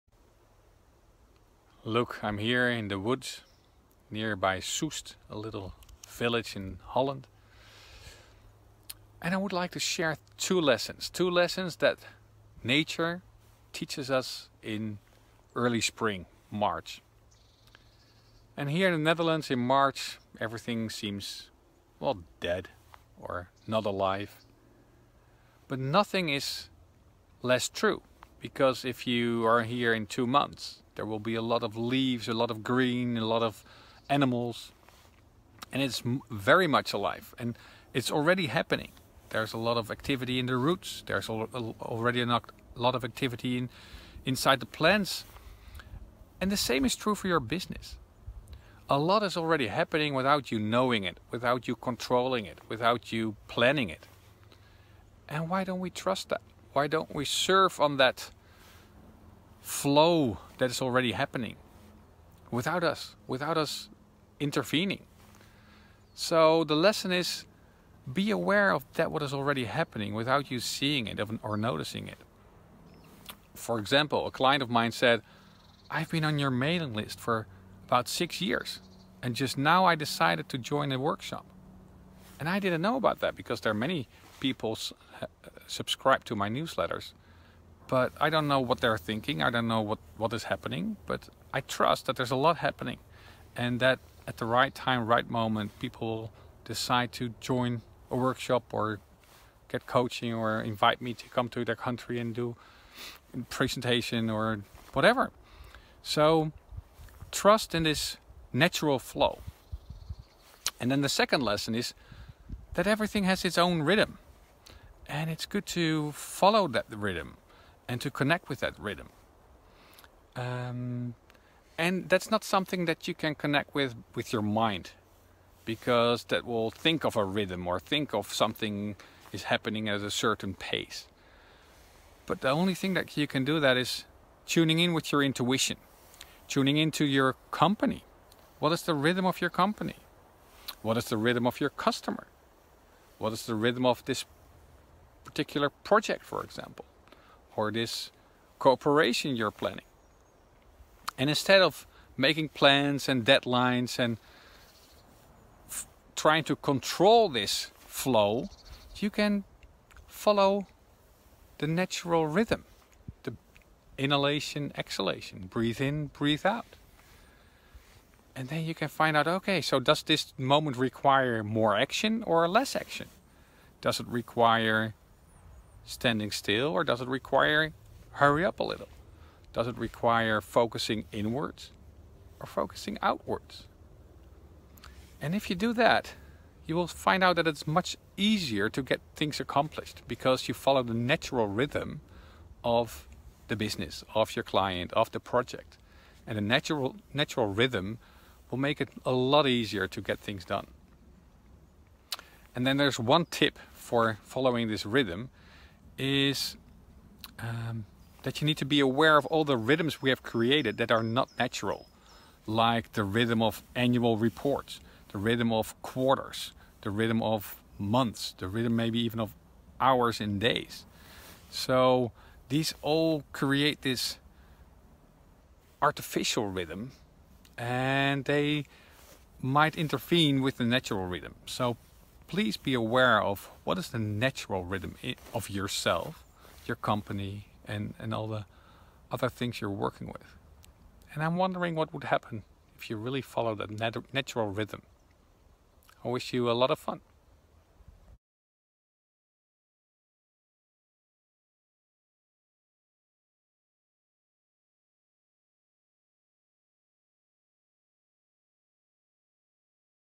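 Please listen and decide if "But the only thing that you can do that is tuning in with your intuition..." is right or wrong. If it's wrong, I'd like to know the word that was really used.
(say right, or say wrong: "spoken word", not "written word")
right.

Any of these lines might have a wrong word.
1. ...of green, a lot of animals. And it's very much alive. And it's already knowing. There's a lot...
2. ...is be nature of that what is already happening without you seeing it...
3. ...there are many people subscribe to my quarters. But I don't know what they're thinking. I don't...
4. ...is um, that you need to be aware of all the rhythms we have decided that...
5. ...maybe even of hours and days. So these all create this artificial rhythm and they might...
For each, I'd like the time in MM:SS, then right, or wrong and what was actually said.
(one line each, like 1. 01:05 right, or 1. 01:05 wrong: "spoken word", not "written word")
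1. 00:32 wrong: "happening", not "knowing"
2. 01:07 wrong: "aware", not "nature"
3. 01:23 wrong: "newsletters", not "quarters"
4. 03:26 wrong: "created", not "decided"
5. 03:38 right.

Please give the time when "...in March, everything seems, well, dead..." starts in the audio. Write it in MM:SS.
00:19.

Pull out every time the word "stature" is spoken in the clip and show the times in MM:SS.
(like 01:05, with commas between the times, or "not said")
not said.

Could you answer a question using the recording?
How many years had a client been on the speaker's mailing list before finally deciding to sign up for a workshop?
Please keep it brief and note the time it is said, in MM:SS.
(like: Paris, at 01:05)
6, at 01:18.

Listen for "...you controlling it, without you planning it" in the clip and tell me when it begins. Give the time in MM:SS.
00:51.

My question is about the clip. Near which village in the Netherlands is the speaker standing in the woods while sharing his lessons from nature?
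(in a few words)
Soest.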